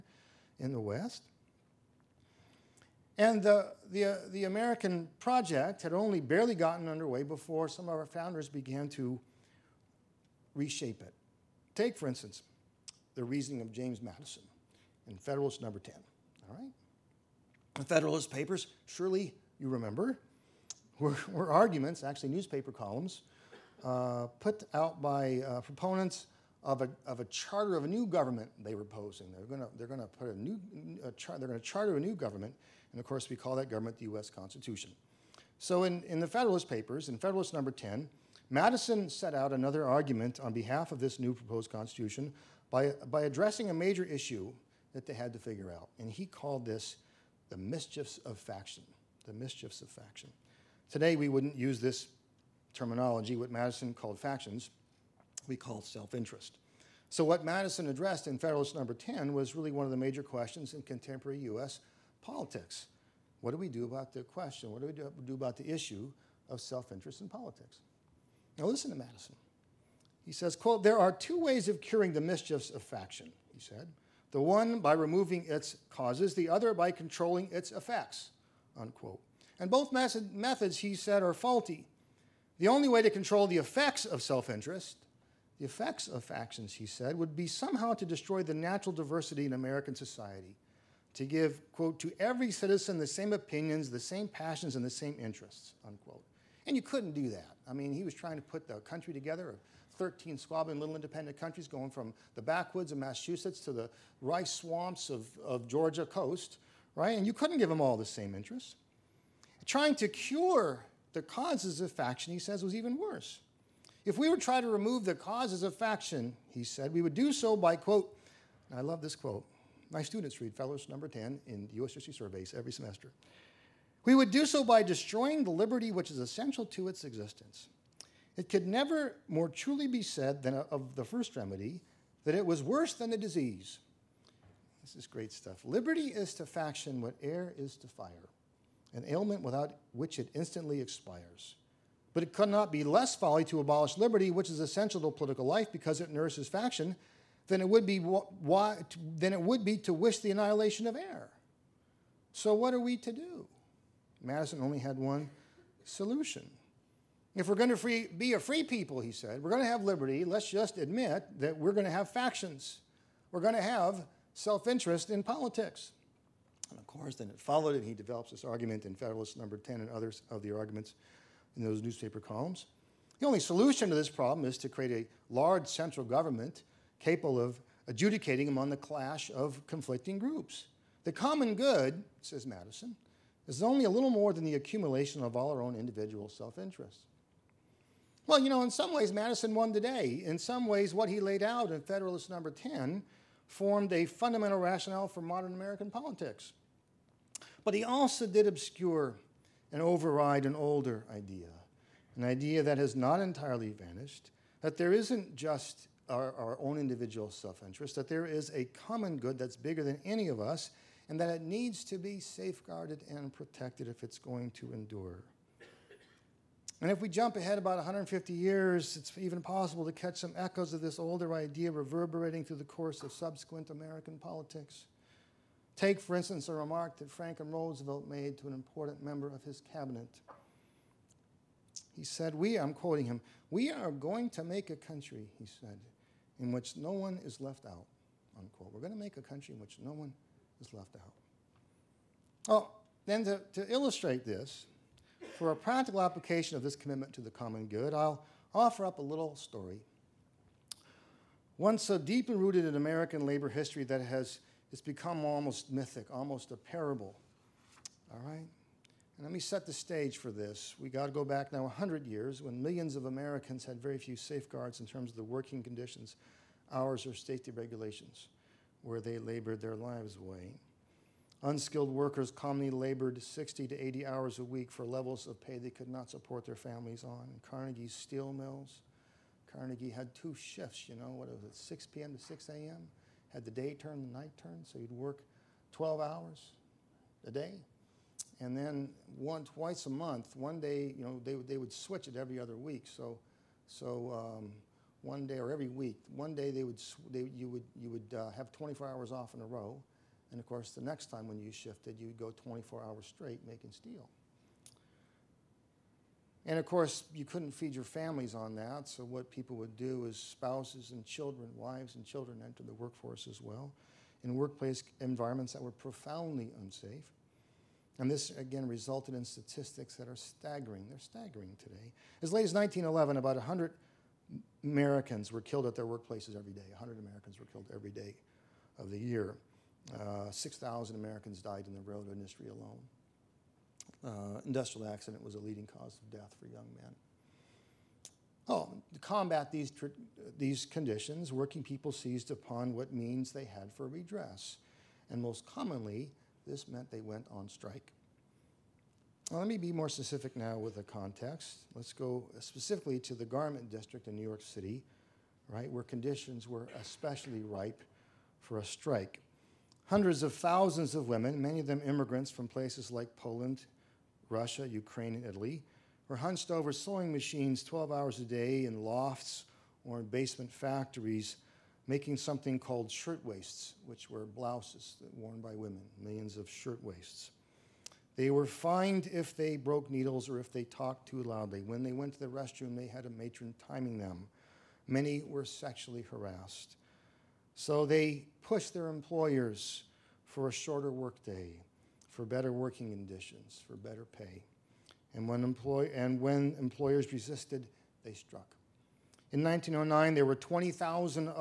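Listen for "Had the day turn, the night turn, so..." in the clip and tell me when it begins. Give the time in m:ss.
4:43.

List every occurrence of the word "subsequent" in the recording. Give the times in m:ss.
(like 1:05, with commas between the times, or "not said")
3:43.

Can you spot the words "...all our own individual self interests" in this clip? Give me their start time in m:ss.
3:05.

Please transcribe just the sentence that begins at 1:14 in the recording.
The one by removing its causes, the other by controlling its effects, unquote.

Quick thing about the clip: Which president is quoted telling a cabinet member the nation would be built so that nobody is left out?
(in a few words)
Franklin Roosevelt.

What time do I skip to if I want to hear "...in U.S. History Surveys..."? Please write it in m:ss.
2:01.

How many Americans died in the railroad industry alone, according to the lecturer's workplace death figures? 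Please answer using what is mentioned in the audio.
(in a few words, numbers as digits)
6,000.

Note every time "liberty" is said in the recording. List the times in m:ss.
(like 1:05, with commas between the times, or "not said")
2:05, 2:15, 2:23, 2:39.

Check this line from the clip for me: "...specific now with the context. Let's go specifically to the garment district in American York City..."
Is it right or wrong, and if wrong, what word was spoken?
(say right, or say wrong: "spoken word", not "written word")
wrong: "New", not "American".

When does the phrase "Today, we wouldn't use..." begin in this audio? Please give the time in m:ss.
0:50.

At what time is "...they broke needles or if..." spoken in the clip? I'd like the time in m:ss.
6:19.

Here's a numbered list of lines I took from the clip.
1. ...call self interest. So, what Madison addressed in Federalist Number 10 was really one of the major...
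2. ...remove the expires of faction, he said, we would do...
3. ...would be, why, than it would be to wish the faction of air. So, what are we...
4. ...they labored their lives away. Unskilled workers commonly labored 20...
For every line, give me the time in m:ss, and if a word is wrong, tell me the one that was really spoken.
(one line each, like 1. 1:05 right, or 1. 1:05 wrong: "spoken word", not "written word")
1. 0:55 right
2. 1:54 wrong: "causes", not "expires"
3. 2:27 wrong: "annihilation", not "faction"
4. 4:28 wrong: "60", not "20".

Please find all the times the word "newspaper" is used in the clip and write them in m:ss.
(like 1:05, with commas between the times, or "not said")
0:22, 2:51.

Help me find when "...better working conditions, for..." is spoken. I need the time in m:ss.
6:32.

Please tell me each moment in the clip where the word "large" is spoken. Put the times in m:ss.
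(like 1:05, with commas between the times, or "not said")
2:55.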